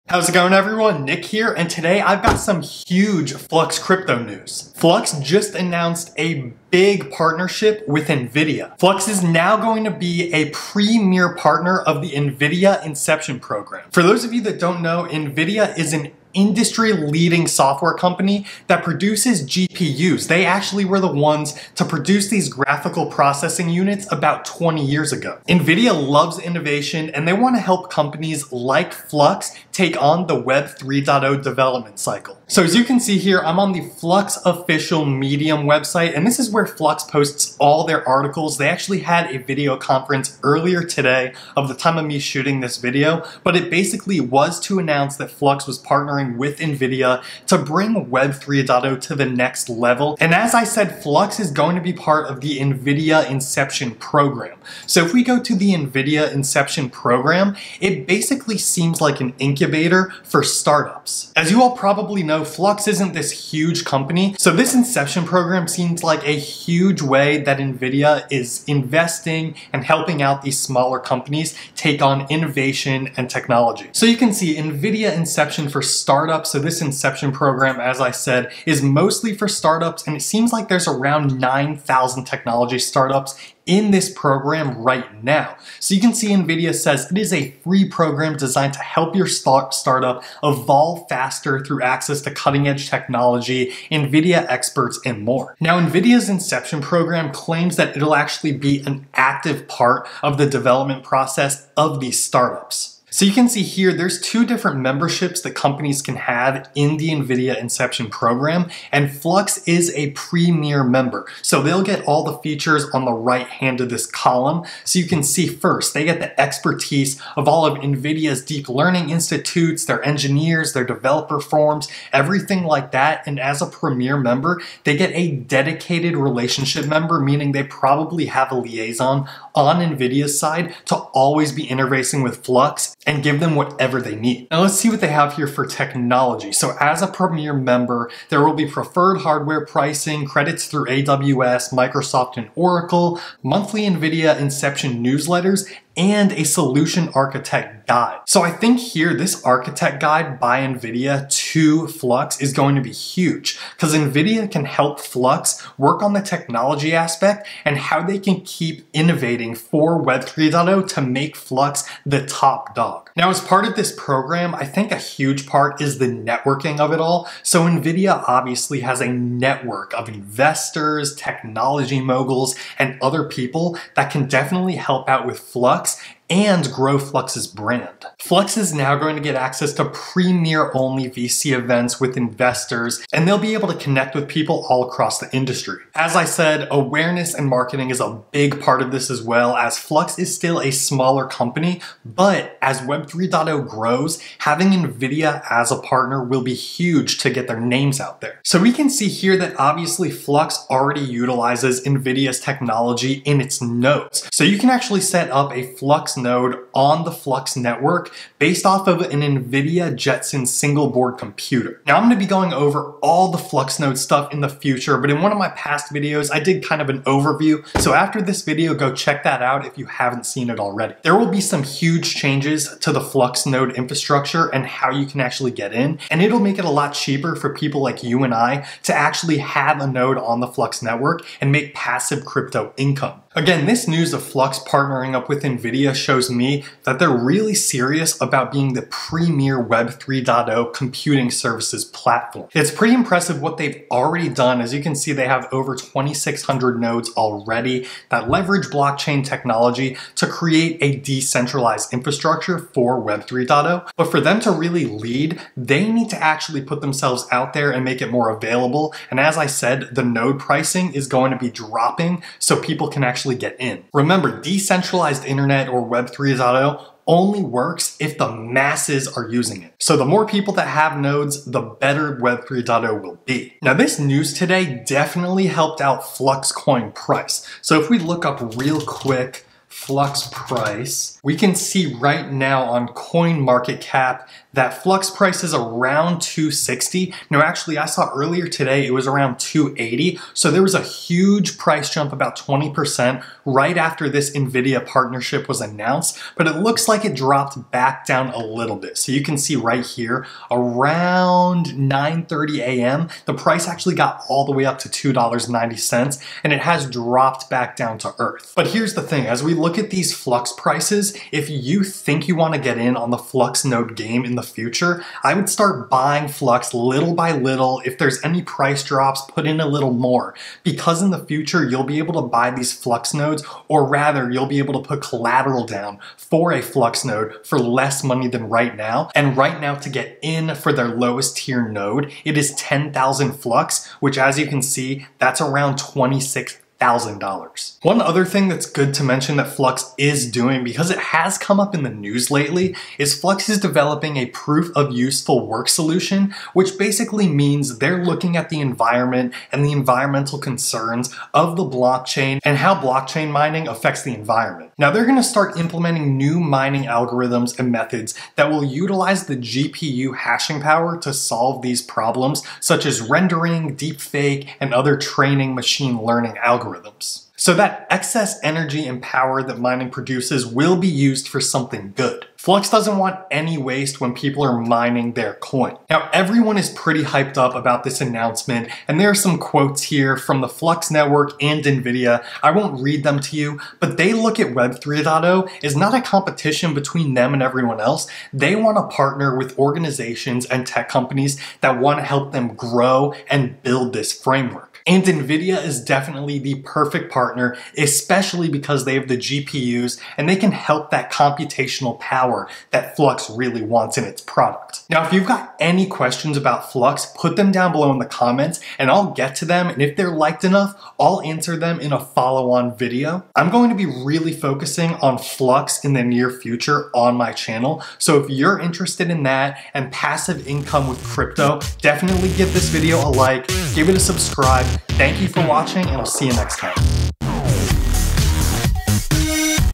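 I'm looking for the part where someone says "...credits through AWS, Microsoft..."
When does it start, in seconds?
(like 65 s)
140 s.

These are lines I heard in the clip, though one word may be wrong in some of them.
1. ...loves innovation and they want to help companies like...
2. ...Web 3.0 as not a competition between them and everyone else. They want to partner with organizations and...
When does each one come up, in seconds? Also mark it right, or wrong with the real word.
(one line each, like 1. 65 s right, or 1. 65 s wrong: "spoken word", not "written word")
1. 25 s right
2. 384 s right.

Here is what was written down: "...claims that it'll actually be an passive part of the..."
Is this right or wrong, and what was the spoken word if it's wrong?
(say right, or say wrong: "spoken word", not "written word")
wrong: "active", not "passive".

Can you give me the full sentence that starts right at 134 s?
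Now let's see what they have here for technology.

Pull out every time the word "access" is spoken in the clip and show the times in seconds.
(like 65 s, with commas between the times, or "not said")
91 s, 179 s.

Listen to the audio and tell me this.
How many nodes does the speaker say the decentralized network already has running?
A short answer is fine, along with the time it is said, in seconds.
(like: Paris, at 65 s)
2,600, at 245 s.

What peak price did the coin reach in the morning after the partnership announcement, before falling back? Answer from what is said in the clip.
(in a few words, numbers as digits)
$2.90.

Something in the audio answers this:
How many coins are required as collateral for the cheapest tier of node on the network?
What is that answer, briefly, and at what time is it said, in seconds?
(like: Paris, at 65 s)
10,000, at 332 s.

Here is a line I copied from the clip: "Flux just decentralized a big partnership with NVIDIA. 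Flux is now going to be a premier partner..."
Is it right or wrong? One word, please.
wrong.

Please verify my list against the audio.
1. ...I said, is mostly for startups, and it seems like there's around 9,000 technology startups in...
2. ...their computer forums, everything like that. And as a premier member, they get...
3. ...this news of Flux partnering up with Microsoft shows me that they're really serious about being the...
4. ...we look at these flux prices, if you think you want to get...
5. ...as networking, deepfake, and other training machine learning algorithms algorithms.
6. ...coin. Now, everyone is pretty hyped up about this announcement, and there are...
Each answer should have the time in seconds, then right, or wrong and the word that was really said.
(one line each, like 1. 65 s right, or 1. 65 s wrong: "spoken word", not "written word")
1. 78 s right
2. 120 s wrong: "developer", not "computer"
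3. 233 s wrong: "NVIDIA", not "Microsoft"
4. 309 s right
5. 362 s wrong: "rendering", not "networking"
6. 375 s right.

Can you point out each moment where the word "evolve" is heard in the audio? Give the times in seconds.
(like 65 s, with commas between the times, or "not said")
90 s.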